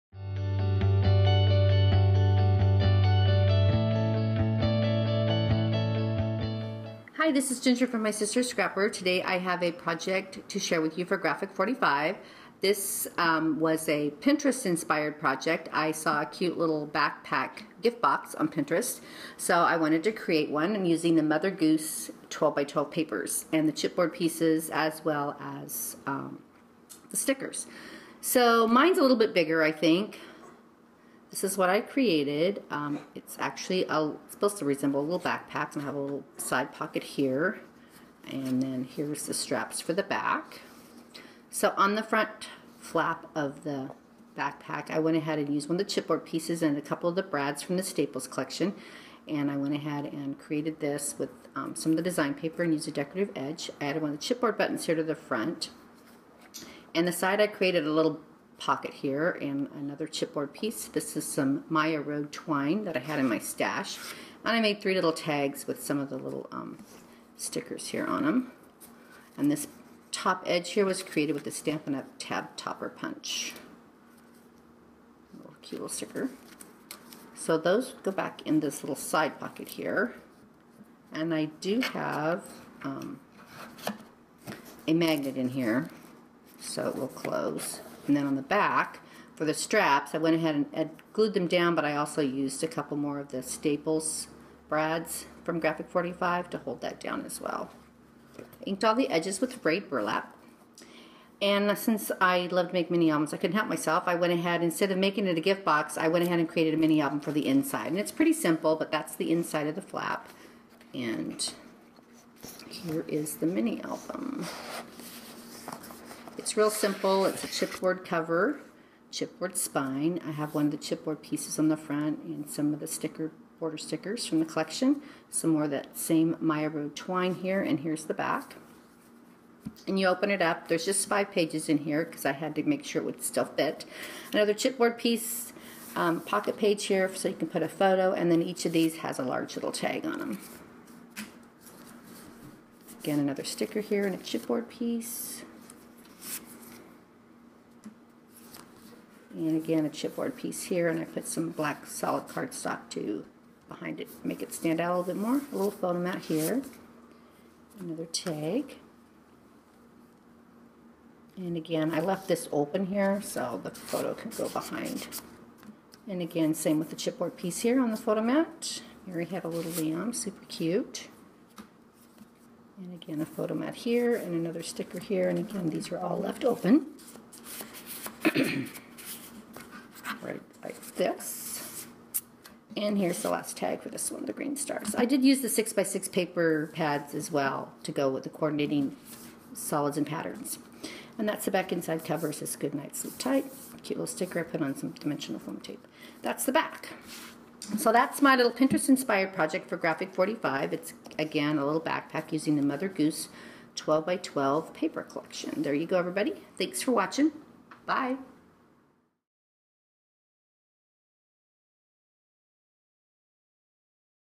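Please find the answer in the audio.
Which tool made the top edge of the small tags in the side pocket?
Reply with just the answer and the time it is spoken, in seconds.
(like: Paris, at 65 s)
Stampin' Up! Tab Topper Punch, at 72 s.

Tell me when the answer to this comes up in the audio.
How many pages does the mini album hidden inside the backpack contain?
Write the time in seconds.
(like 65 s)
131 s.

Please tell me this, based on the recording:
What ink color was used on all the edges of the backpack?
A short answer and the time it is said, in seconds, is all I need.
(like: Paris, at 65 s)
frayed burlap, at 99 s.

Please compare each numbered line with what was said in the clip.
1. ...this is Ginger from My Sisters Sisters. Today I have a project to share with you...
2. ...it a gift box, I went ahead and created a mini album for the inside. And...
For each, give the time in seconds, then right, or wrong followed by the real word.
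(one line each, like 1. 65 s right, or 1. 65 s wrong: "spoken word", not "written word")
1. 7 s wrong: "Scrapper", not "Sisters"
2. 105 s right.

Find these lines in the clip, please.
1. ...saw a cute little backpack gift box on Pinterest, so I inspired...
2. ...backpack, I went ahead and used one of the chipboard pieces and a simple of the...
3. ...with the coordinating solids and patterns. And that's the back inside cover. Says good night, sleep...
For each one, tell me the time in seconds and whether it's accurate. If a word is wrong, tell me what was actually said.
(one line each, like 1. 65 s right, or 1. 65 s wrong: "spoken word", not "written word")
1. 15 s wrong: "wanted", not "inspired"
2. 44 s wrong: "couple", not "simple"
3. 188 s right.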